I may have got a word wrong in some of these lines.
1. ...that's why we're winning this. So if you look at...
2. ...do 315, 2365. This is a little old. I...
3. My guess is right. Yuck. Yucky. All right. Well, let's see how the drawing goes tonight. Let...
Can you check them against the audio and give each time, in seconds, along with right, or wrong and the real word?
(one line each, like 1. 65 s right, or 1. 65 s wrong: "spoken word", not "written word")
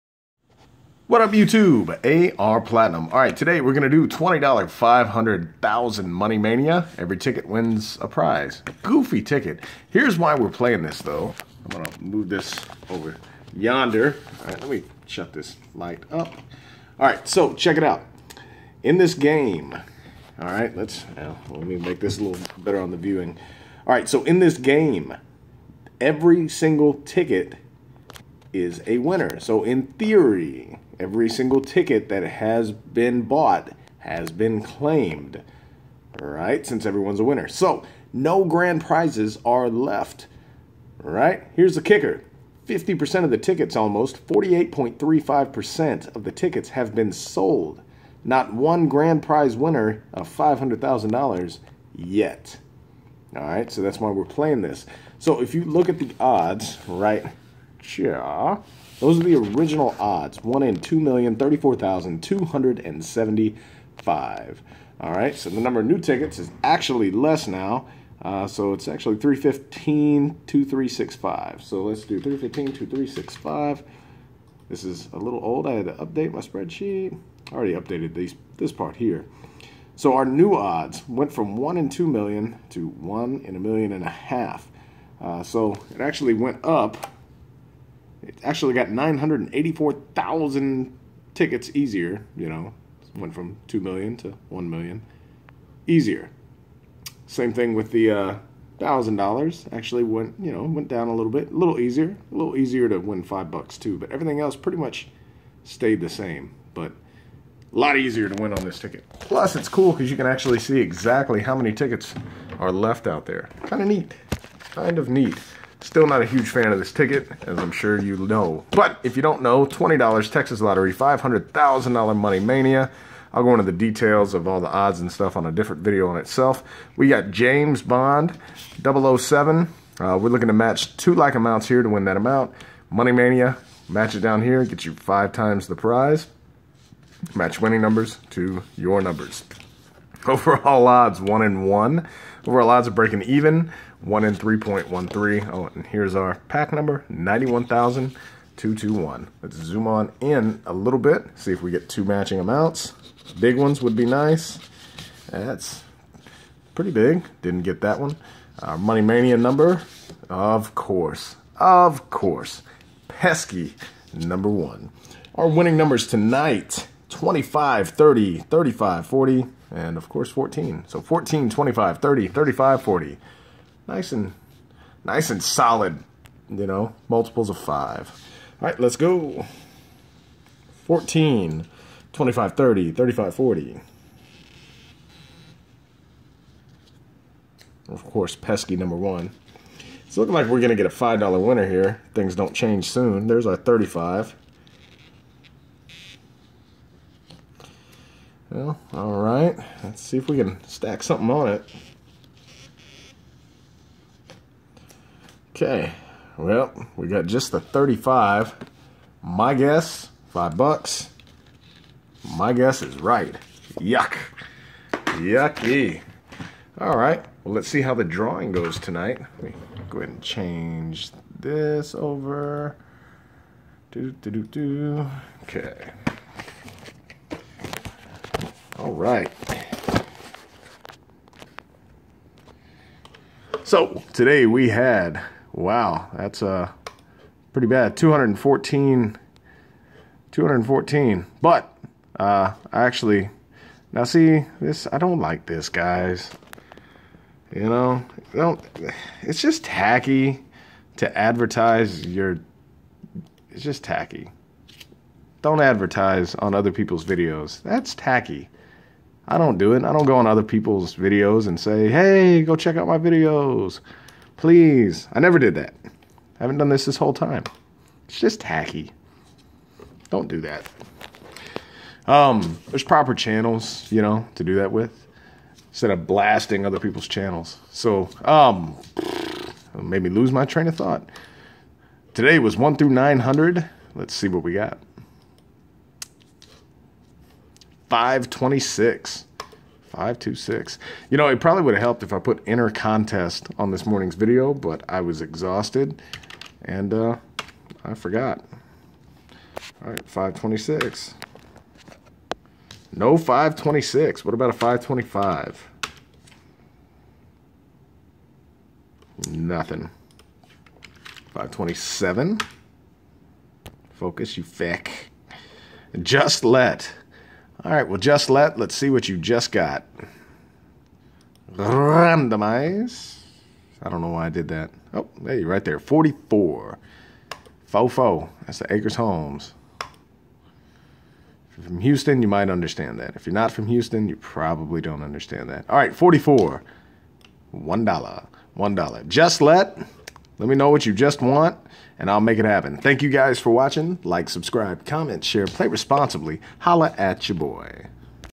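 1. 53 s wrong: "playing", not "winning"
2. 72 s right
3. 212 s right.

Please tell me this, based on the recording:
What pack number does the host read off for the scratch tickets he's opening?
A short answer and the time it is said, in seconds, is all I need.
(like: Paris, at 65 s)
91,221, at 147 s.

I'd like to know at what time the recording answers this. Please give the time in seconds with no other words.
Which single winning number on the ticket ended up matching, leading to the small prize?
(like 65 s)
193 s.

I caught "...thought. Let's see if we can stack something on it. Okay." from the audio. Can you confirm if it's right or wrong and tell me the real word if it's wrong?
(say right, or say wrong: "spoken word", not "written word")
wrong: "alright", not "thought".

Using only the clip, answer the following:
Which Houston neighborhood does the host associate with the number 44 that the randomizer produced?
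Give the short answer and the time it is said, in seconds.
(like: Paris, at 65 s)
Acres Homes, at 328 s.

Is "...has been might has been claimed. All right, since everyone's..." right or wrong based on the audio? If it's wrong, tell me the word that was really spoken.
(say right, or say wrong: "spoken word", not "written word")
wrong: "bought", not "might".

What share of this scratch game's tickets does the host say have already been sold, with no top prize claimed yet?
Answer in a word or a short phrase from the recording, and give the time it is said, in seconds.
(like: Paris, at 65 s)
48.35%, at 44 s.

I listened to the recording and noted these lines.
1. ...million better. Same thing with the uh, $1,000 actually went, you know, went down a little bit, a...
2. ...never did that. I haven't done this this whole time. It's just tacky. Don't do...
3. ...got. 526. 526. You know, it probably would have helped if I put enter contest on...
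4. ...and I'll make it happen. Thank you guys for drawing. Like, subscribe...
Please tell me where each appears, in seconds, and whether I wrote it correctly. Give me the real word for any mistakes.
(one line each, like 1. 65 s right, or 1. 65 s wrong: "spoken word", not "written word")
1. 94 s wrong: "easier", not "better"
2. 265 s right
3. 284 s right
4. 341 s wrong: "watching", not "drawing".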